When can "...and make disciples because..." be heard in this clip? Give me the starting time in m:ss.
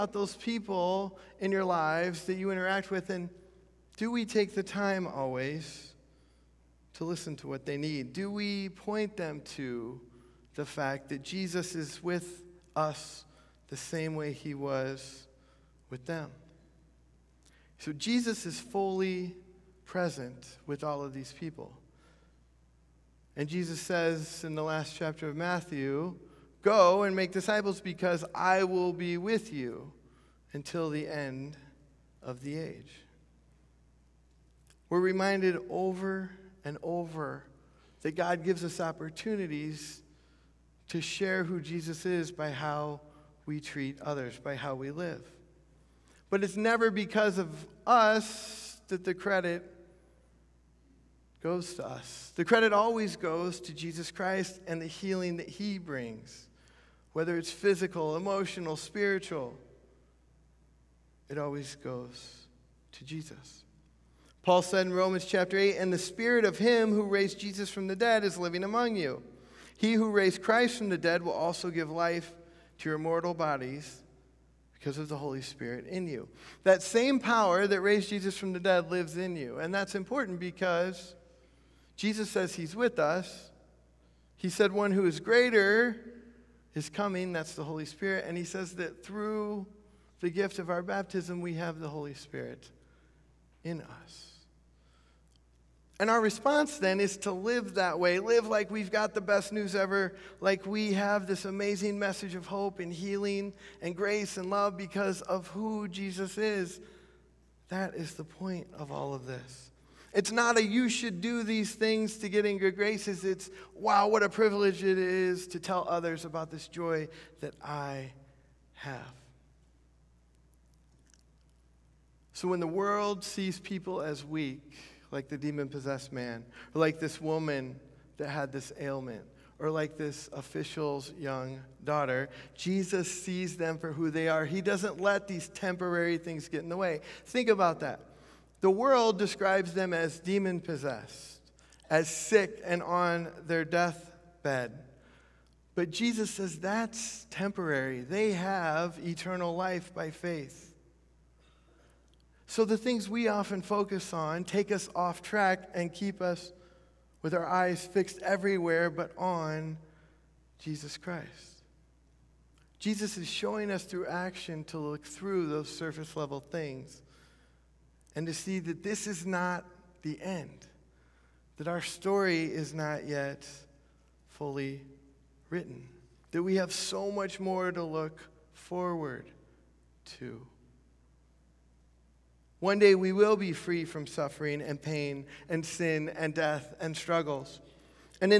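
0:27.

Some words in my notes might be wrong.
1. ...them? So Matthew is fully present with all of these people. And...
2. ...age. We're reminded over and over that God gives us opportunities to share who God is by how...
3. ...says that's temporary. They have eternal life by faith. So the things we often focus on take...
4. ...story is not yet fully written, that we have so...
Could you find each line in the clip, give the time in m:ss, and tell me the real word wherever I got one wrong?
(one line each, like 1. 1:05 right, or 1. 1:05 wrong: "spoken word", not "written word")
1. 0:16 wrong: "Jesus", not "Matthew"
2. 0:32 wrong: "Jesus", not "God"
3. 2:26 right
4. 2:51 right.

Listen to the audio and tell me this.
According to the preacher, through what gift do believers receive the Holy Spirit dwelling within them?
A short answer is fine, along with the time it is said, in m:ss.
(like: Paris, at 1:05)
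baptism, at 1:30.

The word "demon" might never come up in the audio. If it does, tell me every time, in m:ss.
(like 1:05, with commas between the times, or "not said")
2:05, 2:20.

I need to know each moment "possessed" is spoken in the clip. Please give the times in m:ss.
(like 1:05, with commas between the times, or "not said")
2:05, 2:20.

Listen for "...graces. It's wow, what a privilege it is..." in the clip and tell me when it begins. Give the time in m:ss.
1:52.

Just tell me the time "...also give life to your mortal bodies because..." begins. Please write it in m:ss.
1:11.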